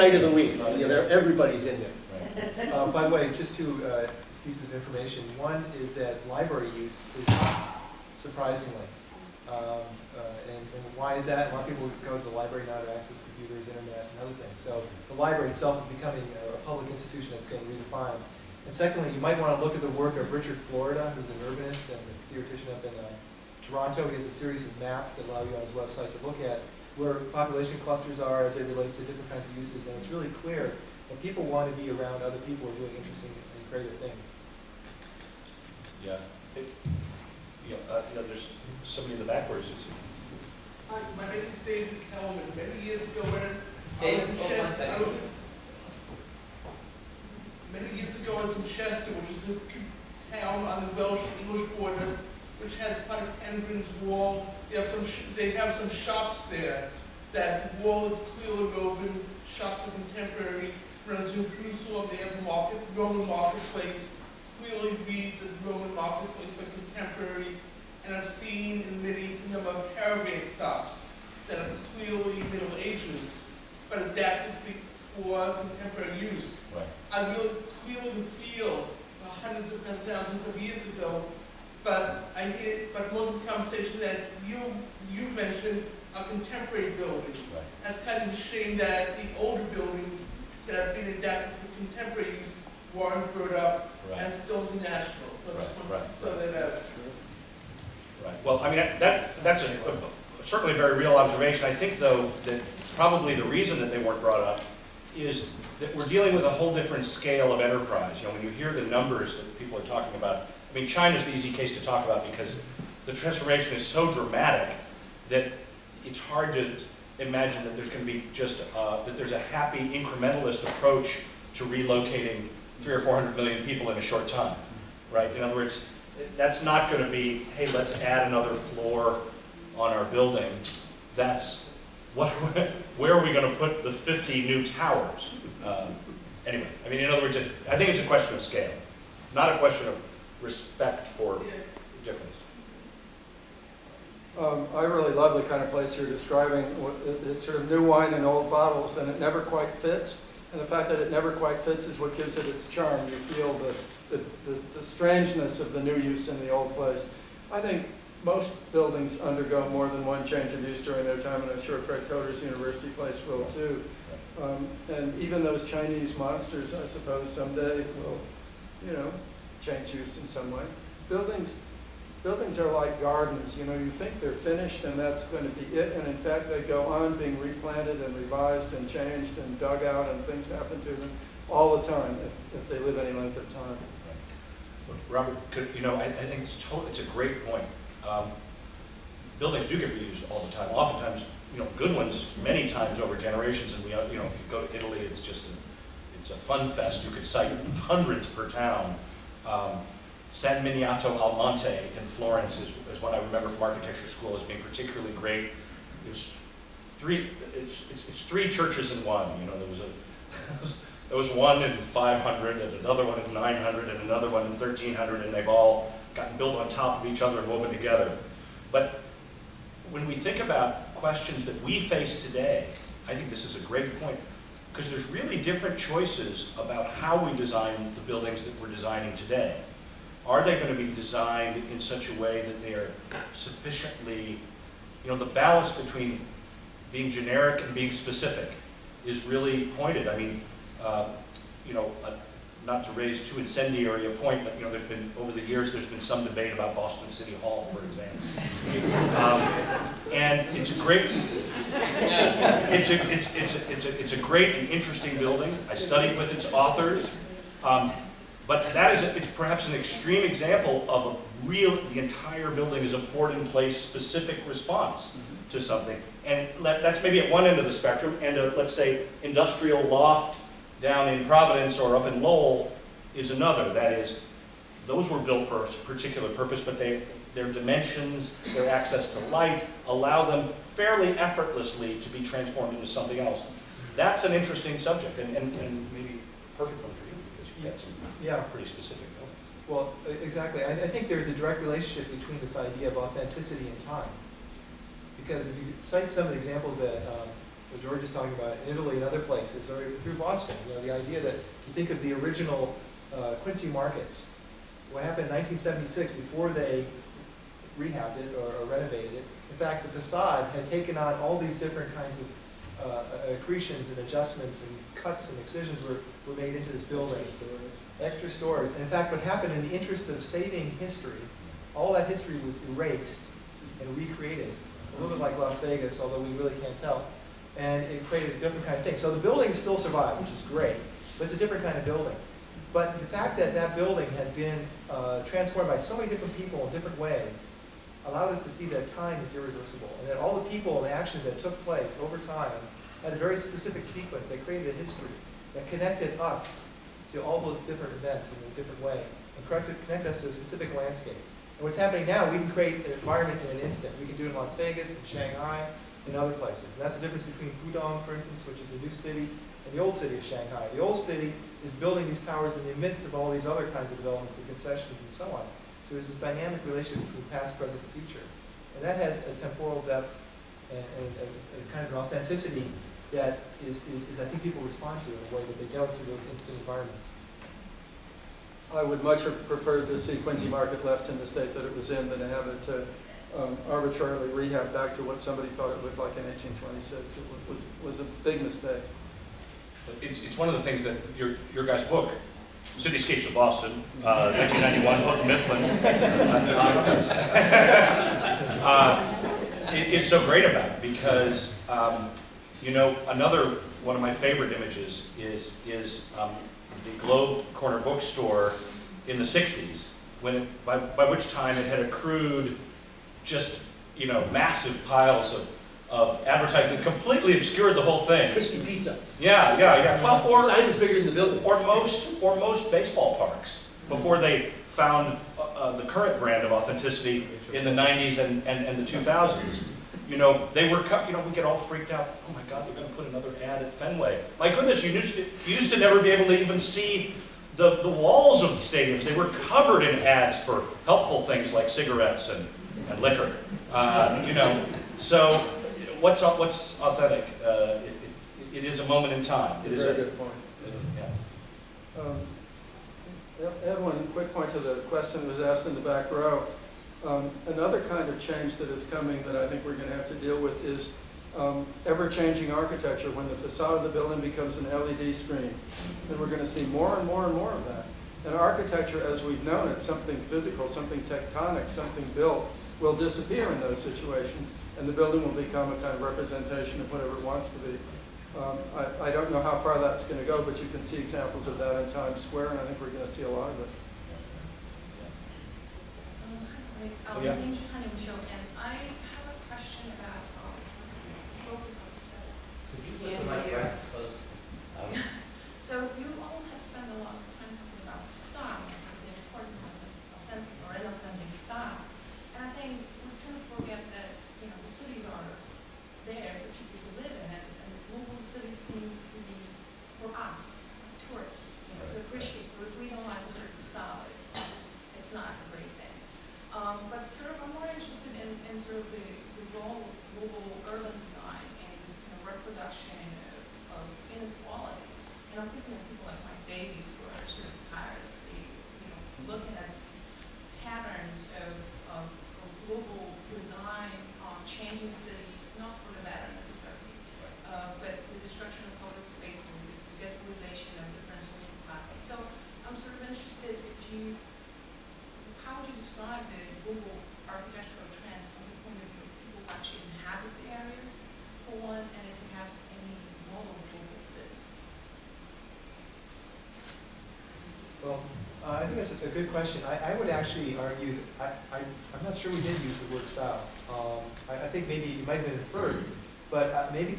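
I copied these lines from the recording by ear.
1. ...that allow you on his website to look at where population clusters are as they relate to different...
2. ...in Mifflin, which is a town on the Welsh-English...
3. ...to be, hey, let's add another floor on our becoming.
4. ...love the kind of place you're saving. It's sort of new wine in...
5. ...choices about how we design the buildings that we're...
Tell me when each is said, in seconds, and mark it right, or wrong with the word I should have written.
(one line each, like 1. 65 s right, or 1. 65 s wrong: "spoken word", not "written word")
1. 25 s right
2. 48 s wrong: "Chester", not "Mifflin"
3. 127 s wrong: "building", not "becoming"
4. 145 s wrong: "describing", not "saving"
5. 225 s right.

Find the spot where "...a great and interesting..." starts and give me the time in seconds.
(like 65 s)
254 s.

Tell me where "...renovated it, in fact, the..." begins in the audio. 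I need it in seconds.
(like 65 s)
308 s.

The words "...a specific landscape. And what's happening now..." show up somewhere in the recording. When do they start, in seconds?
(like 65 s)
350 s.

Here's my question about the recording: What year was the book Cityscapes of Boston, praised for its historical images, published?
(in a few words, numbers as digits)
1991.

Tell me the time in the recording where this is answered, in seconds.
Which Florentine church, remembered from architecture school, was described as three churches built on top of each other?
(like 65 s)
200 s.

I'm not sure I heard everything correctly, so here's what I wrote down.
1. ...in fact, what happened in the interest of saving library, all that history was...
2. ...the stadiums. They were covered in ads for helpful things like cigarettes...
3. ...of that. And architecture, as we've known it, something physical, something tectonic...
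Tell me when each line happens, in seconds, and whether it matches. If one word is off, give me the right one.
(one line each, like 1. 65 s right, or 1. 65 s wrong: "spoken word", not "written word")
1. 318 s wrong: "history", not "library"
2. 438 s right
3. 467 s right.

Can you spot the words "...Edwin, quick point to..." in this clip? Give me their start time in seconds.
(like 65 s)
453 s.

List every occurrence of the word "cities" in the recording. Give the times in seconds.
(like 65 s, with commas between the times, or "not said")
534 s, 554 s.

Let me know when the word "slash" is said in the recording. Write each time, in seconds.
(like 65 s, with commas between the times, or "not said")
not said.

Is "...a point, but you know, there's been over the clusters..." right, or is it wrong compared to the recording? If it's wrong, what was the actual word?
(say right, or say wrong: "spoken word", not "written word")
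wrong: "years", not "clusters".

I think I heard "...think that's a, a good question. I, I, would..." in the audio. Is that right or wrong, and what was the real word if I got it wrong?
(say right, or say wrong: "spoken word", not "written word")
right.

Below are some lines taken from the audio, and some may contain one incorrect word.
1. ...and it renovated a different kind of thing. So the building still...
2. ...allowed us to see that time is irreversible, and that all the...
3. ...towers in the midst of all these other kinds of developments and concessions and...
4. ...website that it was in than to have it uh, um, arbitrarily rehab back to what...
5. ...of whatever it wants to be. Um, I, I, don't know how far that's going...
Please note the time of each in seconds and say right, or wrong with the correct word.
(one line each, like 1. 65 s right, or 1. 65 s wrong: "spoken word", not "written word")
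1. 327 s wrong: "created", not "renovated"
2. 338 s right
3. 362 s right
4. 381 s wrong: "state", not "website"
5. 476 s right.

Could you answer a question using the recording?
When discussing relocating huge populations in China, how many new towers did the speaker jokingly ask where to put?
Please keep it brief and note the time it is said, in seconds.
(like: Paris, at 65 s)
50, at 133 s.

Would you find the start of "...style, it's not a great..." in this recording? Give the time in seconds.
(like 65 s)
513 s.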